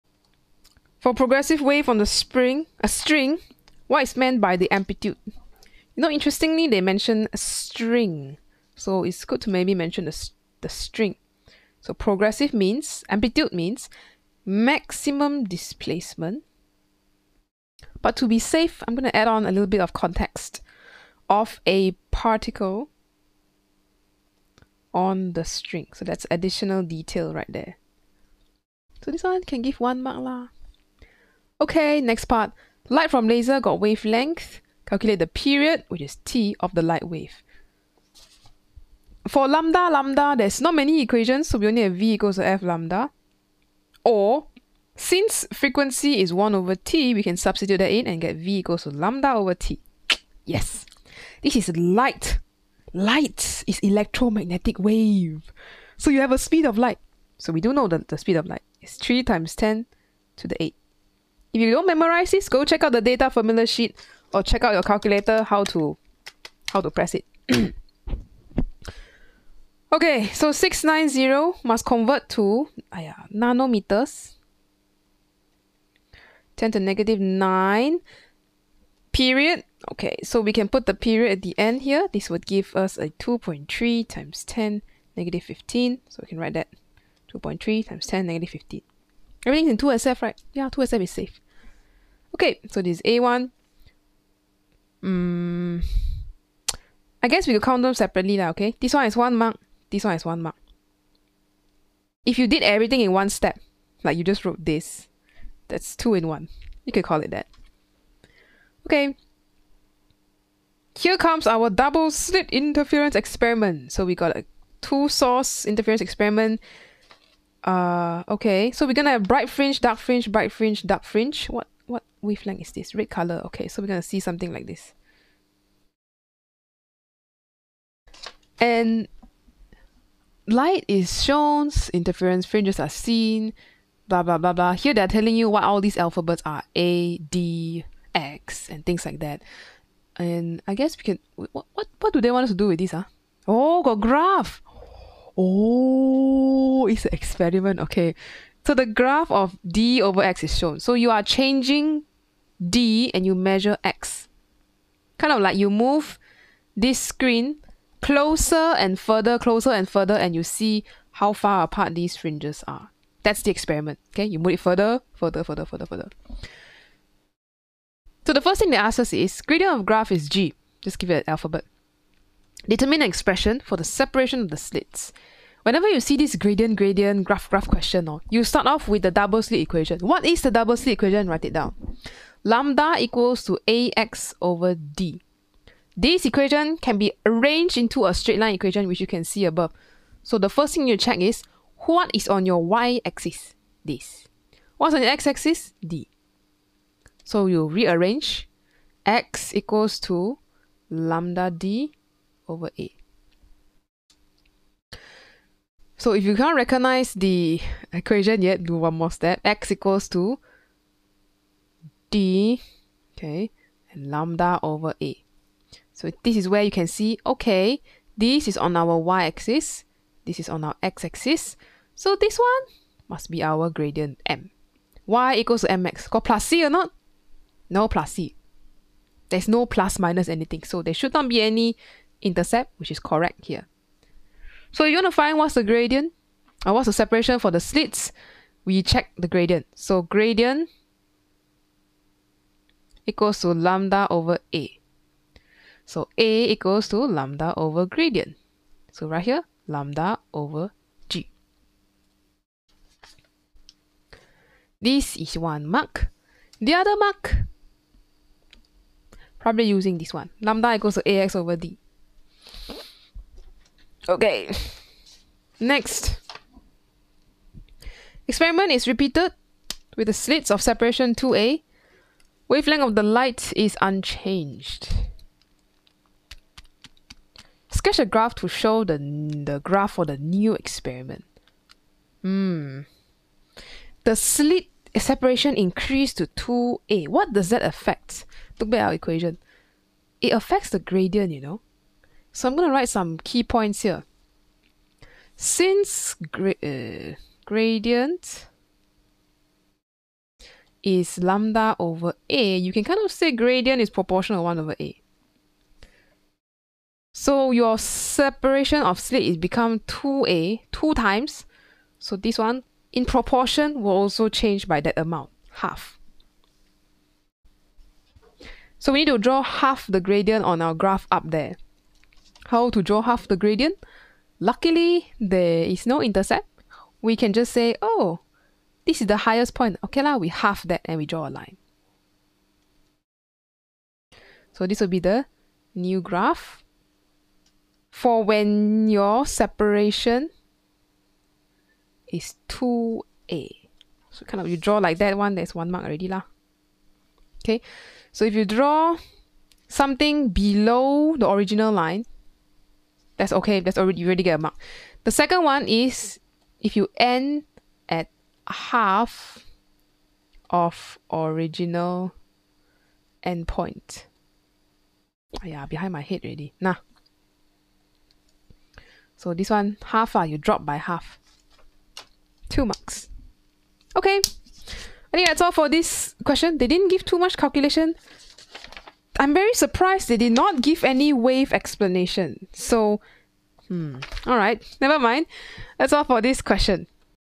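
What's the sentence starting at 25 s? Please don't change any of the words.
So that's additional detail right there.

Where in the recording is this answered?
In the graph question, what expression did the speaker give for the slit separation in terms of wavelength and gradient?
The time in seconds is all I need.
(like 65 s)
249 s.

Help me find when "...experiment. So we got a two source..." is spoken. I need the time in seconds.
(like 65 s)
113 s.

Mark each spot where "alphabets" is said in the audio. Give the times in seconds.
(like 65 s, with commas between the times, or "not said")
135 s, 171 s.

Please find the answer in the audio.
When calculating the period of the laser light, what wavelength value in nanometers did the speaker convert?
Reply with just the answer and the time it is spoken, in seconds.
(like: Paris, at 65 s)
690, at 70 s.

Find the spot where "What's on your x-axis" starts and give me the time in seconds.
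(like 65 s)
194 s.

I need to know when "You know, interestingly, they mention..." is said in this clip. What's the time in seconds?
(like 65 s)
5 s.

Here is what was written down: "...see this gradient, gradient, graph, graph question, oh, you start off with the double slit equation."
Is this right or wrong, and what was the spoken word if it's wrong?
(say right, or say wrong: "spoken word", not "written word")
right.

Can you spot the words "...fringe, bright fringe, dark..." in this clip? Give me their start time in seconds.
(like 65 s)
119 s.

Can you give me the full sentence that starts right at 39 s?
For lambda, lambda, there's not many equations, so we only have v equals to f lambda.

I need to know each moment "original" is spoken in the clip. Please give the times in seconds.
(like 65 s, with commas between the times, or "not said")
351 s, 361 s.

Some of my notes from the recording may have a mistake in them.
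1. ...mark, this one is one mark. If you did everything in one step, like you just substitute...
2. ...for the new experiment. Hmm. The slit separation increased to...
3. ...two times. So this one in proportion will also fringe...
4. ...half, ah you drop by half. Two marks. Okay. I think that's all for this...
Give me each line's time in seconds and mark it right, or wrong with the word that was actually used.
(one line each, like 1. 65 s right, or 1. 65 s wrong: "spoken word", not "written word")
1. 99 s wrong: "wrote", not "substitute"
2. 279 s right
3. 310 s wrong: "change", not "fringe"
4. 369 s right.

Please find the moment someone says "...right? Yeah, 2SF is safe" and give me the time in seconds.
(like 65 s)
90 s.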